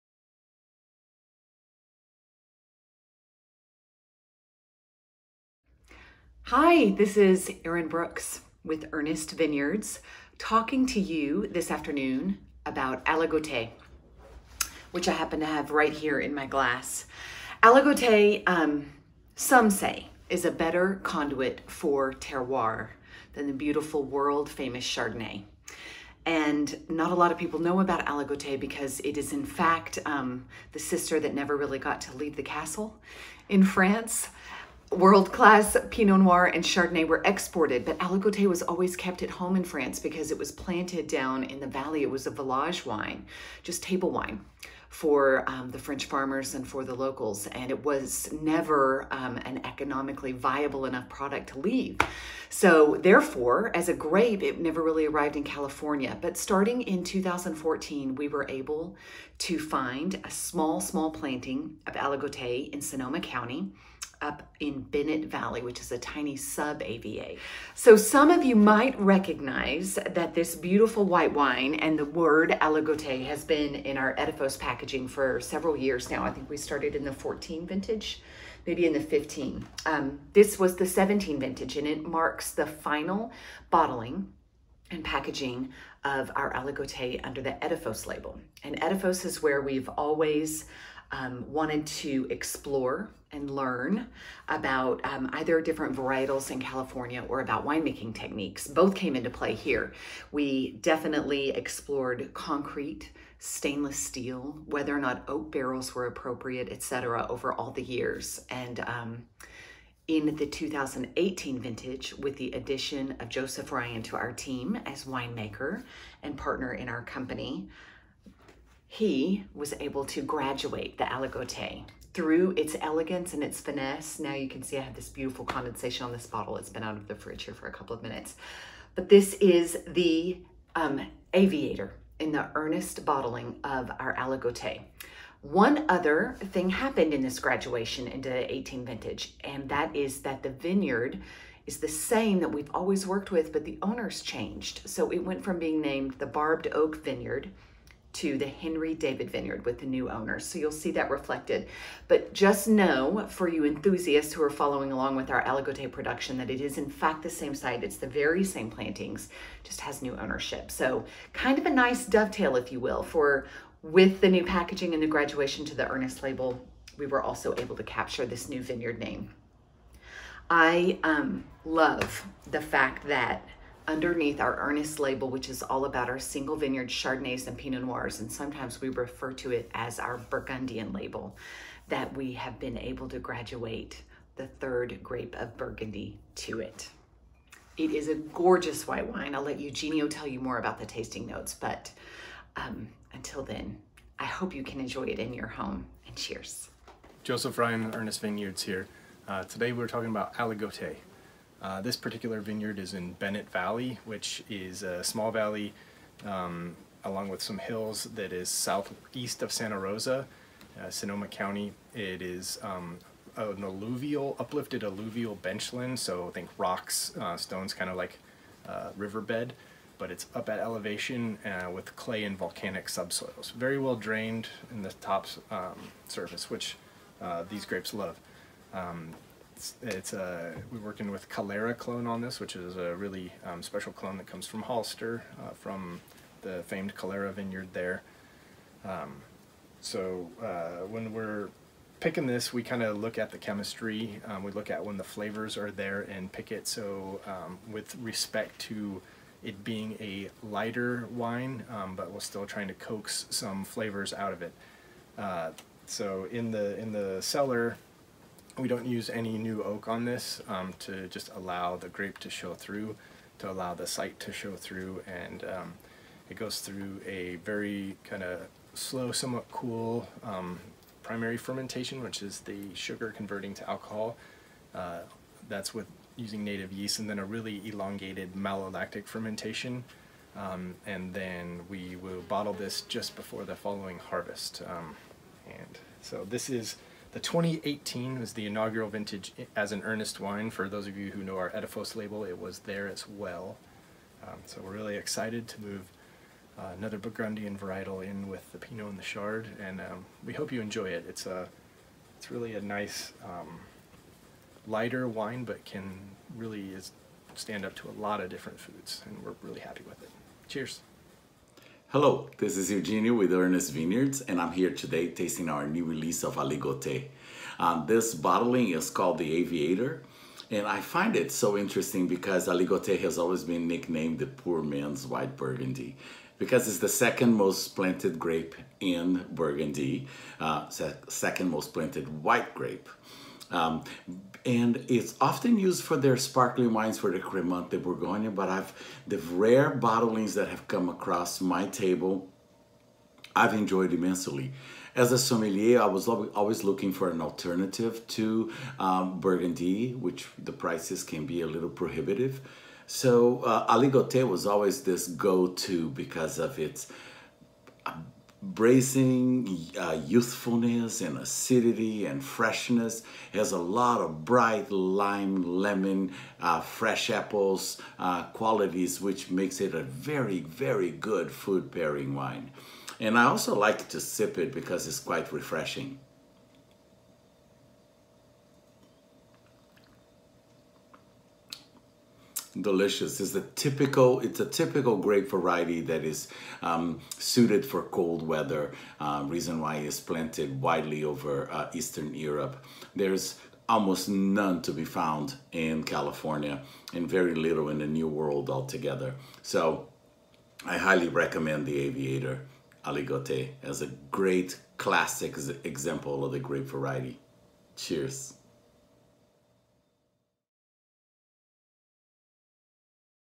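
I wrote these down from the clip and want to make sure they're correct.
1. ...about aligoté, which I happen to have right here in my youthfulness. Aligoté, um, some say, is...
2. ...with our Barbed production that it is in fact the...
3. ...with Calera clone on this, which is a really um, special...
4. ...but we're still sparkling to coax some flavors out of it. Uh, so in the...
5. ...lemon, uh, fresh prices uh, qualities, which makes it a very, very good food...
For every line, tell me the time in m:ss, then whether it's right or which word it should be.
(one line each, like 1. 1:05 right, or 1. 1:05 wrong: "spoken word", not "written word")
1. 0:12 wrong: "glass", not "youthfulness"
2. 2:35 wrong: "Aligoté", not "Barbed"
3. 3:51 right
4. 4:11 wrong: "trying", not "sparkling"
5. 6:05 wrong: "apples", not "prices".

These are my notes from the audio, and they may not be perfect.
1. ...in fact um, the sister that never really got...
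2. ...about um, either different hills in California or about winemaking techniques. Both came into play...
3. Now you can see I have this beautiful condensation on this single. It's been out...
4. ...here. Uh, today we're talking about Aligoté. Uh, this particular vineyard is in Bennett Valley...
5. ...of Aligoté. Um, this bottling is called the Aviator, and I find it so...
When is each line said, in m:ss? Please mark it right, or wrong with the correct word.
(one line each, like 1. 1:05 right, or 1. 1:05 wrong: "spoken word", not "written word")
1. 0:29 right
2. 1:34 wrong: "varietals", not "hills"
3. 2:04 wrong: "bottle", not "single"
4. 3:18 right
5. 5:16 right.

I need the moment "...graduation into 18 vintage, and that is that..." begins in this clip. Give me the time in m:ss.
2:17.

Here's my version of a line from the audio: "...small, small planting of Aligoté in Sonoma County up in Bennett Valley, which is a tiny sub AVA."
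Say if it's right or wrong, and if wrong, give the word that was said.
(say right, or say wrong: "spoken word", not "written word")
right.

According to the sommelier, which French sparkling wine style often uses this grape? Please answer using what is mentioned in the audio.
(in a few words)
Cremant.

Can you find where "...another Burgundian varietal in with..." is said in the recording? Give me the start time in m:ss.
4:56.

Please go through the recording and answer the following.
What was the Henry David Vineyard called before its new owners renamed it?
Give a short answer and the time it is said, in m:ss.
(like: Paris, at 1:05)
Barbed Oak Vineyard, at 2:26.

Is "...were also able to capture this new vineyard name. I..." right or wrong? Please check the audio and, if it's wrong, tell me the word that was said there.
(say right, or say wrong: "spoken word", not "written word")
right.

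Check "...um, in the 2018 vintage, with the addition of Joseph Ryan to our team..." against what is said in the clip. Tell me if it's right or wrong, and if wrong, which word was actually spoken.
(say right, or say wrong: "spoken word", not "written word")
right.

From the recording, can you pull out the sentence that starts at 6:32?
There's almost none to be found in California and very little in the New World altogether.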